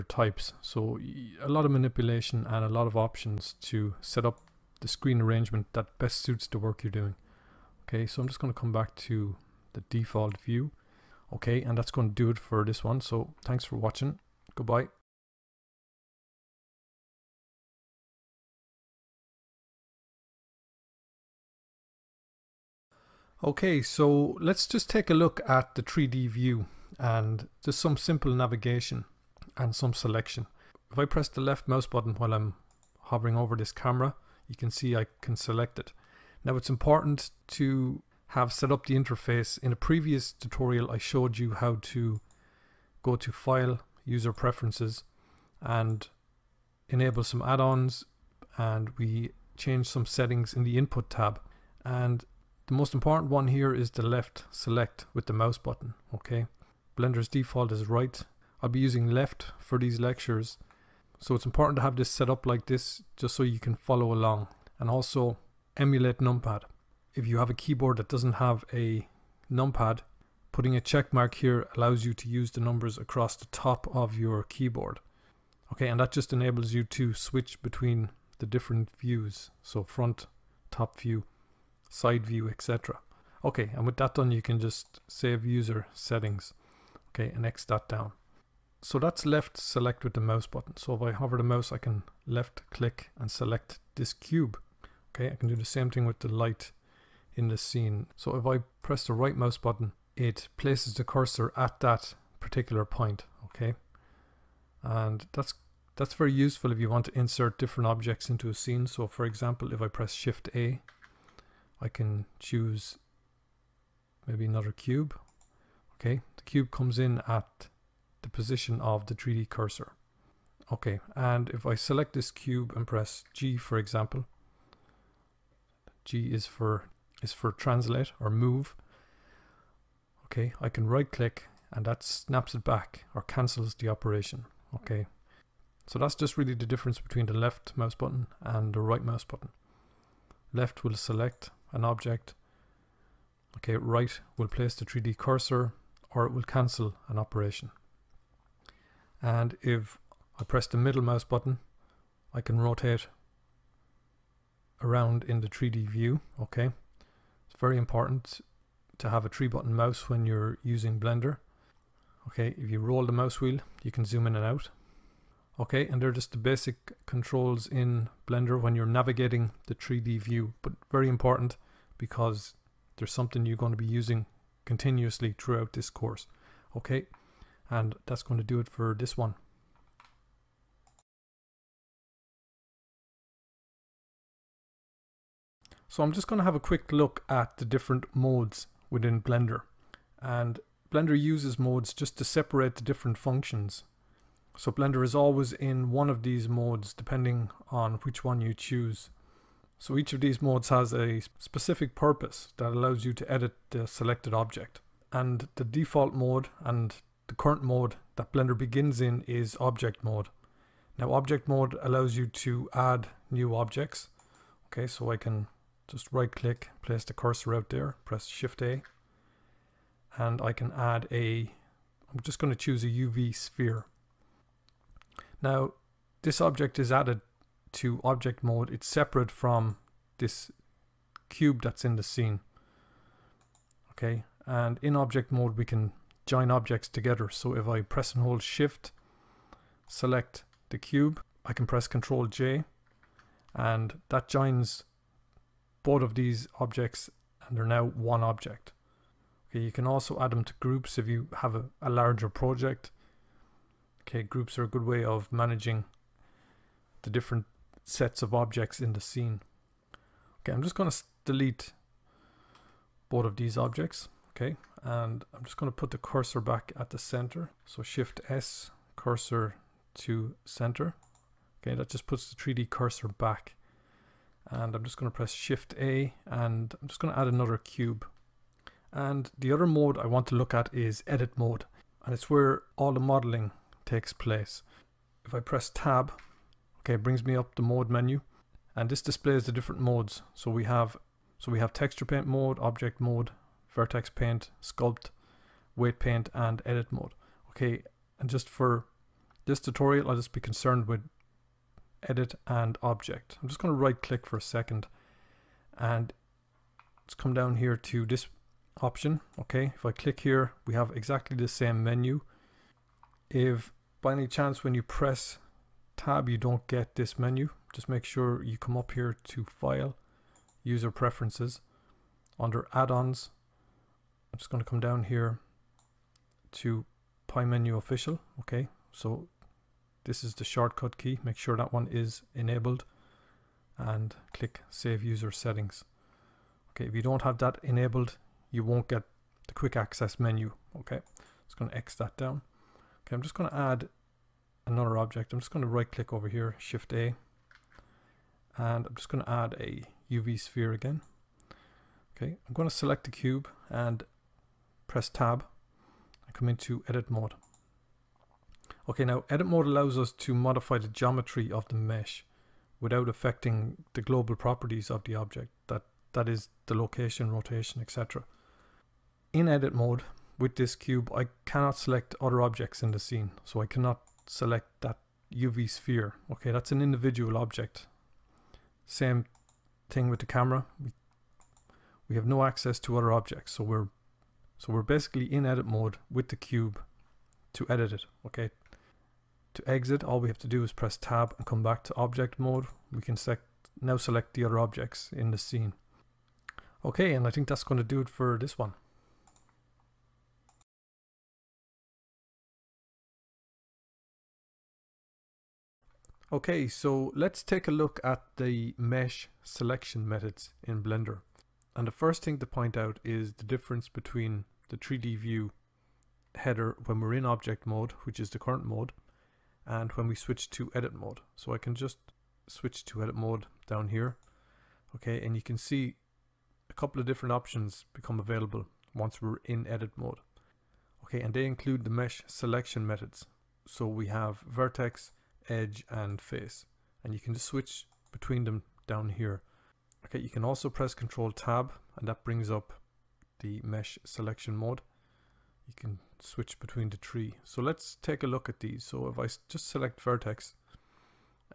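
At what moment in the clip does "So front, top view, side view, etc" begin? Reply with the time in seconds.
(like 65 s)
79 s.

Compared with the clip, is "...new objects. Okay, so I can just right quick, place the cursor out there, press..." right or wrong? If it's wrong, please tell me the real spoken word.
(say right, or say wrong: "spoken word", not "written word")
wrong: "click", not "quick".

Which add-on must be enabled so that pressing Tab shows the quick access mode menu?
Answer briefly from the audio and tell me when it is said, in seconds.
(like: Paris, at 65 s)
Pie Menu Official, at 327 s.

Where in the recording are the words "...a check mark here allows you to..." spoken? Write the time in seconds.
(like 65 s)
70 s.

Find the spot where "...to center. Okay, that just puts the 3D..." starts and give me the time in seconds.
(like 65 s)
269 s.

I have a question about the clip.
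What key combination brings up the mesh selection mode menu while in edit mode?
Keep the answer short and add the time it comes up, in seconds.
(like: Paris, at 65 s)
Control Tab, at 440 s.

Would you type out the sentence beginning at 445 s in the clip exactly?
You can switch between the tree.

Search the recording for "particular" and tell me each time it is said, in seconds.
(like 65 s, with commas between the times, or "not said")
102 s.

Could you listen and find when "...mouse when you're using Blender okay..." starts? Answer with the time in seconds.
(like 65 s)
159 s.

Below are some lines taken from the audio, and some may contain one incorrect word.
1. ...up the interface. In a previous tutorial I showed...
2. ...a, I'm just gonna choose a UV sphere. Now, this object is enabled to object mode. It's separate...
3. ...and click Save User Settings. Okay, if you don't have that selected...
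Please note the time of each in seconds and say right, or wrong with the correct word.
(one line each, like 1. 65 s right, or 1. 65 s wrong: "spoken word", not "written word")
1. 38 s right
2. 221 s wrong: "added", not "enabled"
3. 333 s wrong: "enabled", not "selected".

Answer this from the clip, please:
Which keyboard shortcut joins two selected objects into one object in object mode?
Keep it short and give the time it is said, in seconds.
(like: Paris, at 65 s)
Control J, at 241 s.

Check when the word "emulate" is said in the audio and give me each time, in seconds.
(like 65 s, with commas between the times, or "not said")
65 s.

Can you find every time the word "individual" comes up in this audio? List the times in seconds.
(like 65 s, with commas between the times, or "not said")
376 s.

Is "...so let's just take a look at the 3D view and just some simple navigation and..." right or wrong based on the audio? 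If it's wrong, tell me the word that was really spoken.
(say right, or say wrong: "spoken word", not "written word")
right.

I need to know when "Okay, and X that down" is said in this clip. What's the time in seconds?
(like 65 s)
87 s.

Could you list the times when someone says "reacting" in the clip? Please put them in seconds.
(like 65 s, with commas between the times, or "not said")
not said.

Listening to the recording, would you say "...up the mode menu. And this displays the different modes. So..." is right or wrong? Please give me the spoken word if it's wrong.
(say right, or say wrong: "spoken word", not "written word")
right.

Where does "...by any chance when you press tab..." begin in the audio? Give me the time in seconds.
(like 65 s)
314 s.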